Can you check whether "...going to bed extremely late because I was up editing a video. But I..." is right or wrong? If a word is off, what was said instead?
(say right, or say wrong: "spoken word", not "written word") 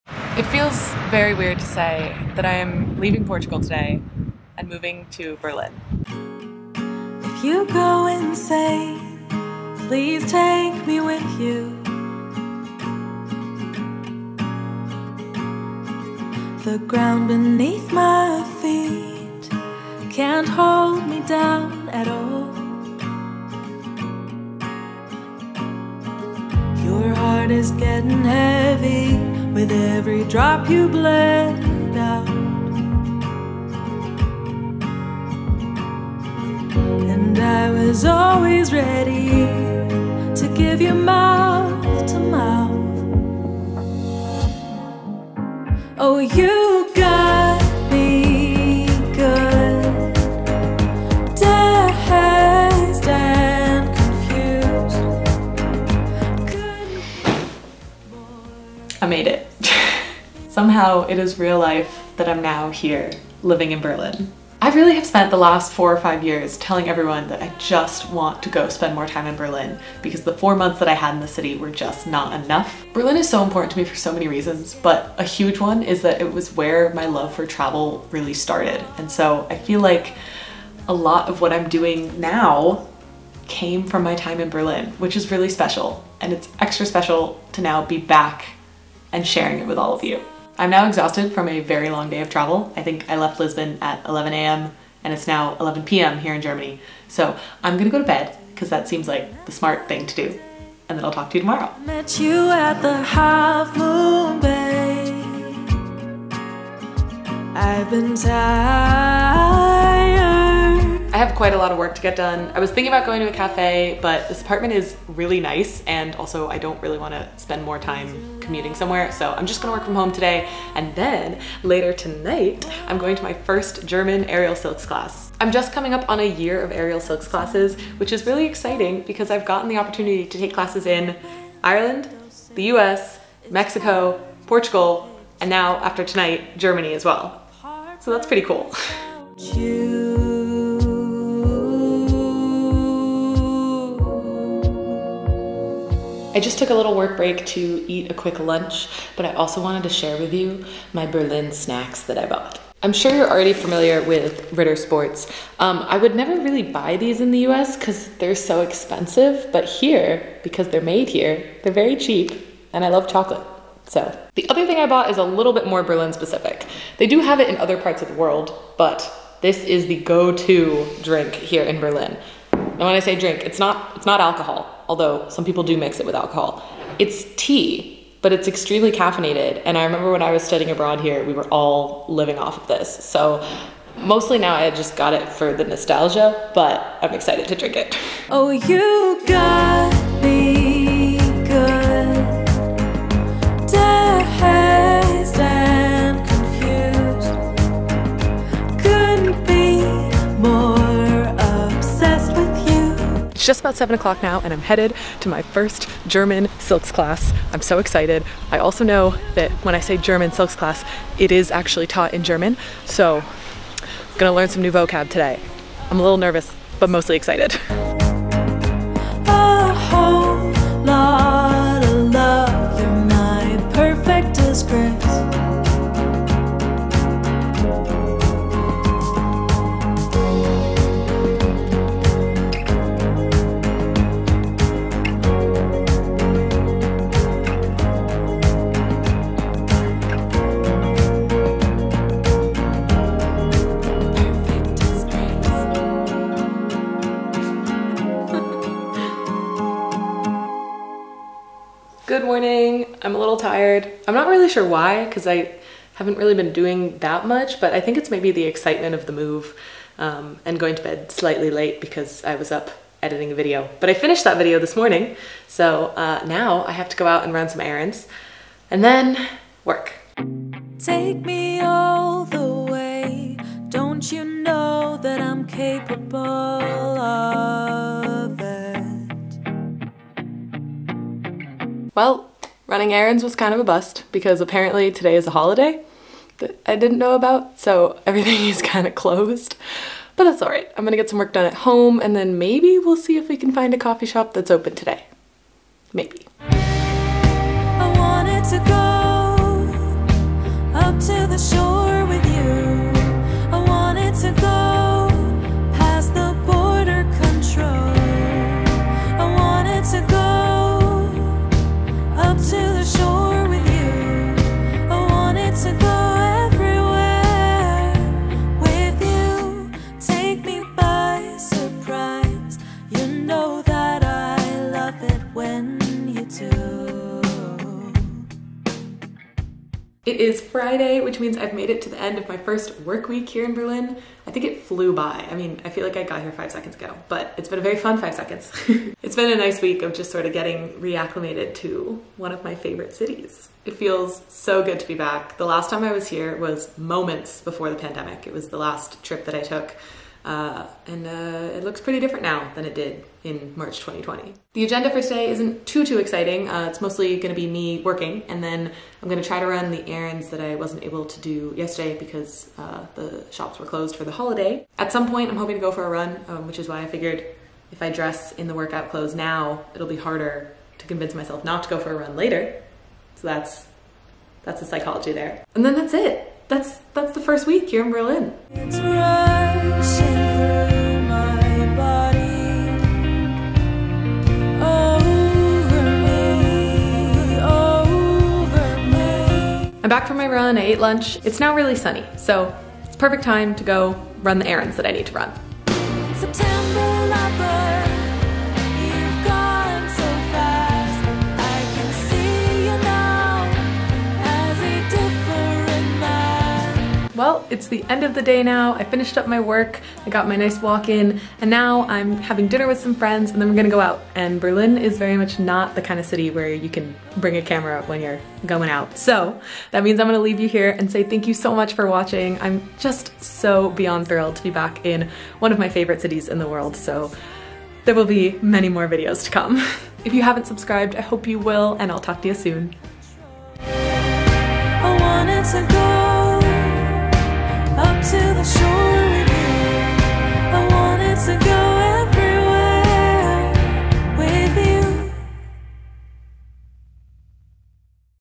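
wrong: "slightly", not "extremely".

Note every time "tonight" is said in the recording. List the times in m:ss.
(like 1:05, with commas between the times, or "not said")
2:01, 2:16.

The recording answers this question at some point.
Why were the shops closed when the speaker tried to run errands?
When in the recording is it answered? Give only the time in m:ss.
4:45.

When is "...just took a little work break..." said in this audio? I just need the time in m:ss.
2:26.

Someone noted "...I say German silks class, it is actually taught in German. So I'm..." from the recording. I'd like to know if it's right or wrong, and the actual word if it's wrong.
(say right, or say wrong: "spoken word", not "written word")
right.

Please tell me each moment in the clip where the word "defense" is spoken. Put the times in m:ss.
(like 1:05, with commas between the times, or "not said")
not said.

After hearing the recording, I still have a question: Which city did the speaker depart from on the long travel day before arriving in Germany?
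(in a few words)
Lisbon.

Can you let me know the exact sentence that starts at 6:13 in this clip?
So that's that's the psychology there.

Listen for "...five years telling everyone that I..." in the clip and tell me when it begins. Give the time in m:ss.
1:06.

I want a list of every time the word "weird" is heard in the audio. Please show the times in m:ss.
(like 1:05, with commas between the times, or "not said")
0:01.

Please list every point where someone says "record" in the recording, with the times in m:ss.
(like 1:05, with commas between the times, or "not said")
not said.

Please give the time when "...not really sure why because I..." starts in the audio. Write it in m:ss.
4:14.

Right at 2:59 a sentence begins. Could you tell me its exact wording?
And I remember when I was studying abroad here, we were all living off of this.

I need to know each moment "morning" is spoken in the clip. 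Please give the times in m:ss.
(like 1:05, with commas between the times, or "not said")
4:12, 4:24.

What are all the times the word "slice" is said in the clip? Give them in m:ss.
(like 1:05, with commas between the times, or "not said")
not said.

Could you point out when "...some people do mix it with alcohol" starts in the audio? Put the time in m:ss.
2:55.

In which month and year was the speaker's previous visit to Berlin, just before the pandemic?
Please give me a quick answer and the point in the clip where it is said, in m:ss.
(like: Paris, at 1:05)
March 2020, at 5:53.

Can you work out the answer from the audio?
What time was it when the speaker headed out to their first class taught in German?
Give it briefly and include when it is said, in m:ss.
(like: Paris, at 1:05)
7, at 3:23.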